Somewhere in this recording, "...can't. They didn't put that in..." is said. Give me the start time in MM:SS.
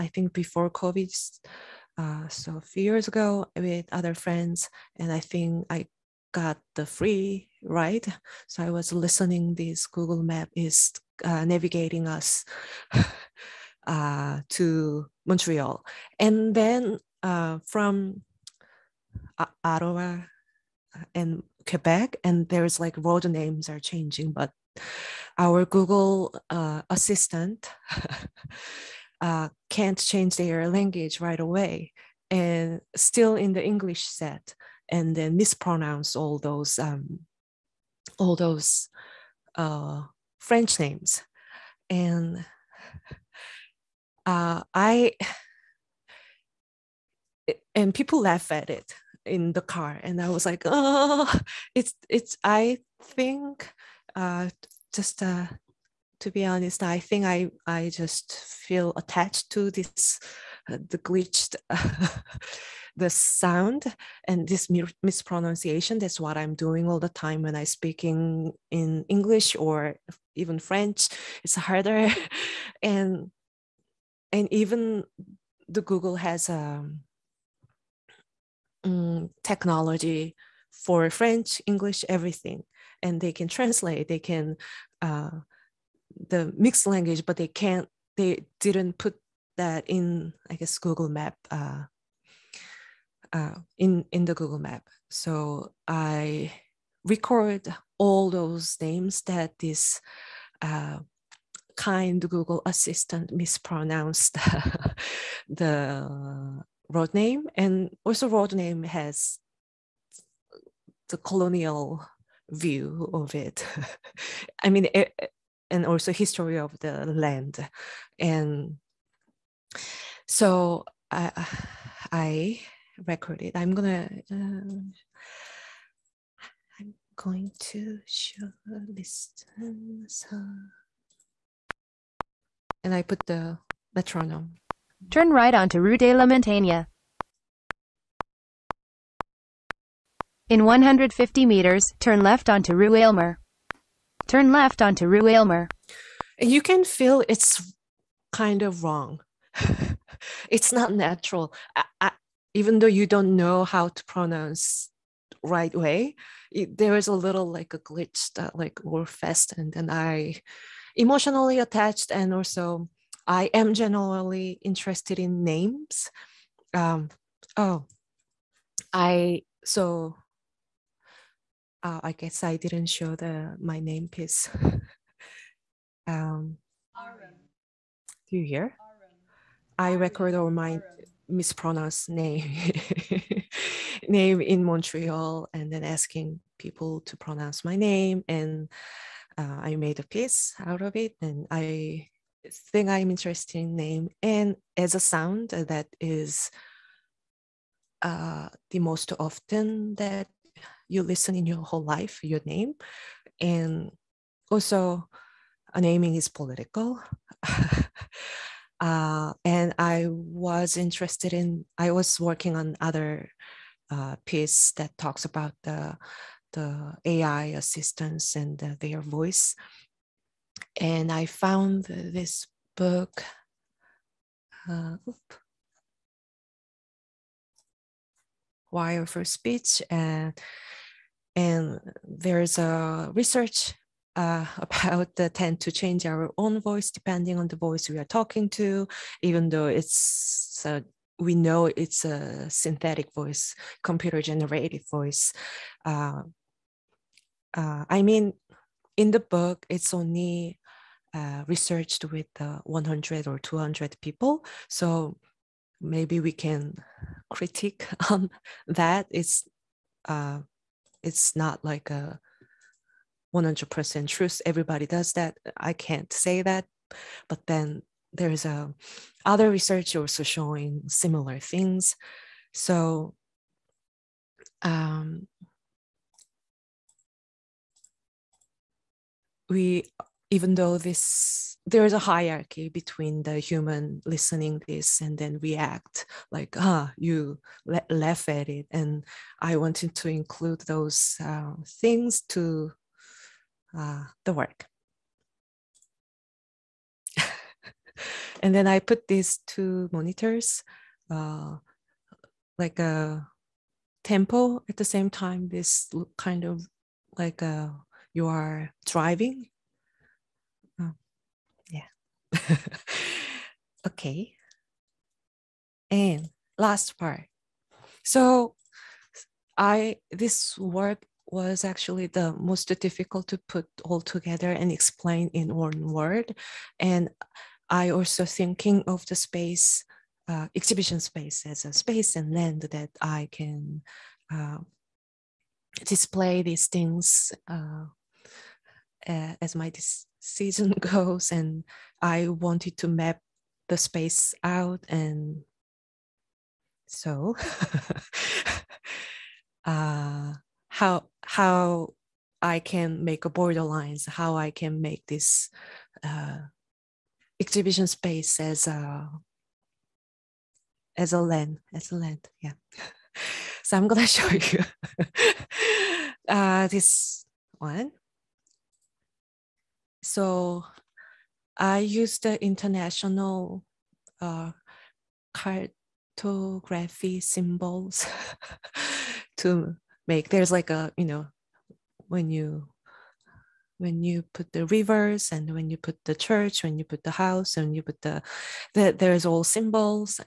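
01:27.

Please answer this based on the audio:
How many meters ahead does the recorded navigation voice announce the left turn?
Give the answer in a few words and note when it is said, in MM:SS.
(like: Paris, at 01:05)
150, at 02:20.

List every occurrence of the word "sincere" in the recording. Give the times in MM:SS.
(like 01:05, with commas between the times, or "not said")
not said.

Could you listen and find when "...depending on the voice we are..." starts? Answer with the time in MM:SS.
03:56.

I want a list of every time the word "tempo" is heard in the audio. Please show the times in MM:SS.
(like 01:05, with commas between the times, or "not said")
05:04.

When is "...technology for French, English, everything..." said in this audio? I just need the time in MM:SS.
01:19.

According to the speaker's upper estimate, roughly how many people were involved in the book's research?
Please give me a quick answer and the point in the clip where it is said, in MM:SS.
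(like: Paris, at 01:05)
200, at 04:13.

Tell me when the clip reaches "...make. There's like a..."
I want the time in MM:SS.
06:20.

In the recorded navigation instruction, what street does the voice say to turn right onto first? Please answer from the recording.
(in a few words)
Rue de la Montagne.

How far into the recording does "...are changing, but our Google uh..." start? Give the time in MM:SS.
00:23.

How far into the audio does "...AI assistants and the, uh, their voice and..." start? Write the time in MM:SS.
03:37.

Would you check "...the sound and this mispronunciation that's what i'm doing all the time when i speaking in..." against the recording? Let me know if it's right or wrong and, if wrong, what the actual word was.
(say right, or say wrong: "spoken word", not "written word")
right.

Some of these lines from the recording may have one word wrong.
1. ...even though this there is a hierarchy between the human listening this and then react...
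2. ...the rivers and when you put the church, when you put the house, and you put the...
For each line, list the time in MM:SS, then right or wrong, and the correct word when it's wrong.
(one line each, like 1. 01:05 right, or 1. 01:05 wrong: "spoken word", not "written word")
1. 04:40 right
2. 06:24 right.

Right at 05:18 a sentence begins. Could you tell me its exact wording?
So I this work was actually the most difficult to put all together and explain in one word.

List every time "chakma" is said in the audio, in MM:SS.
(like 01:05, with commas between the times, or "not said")
not said.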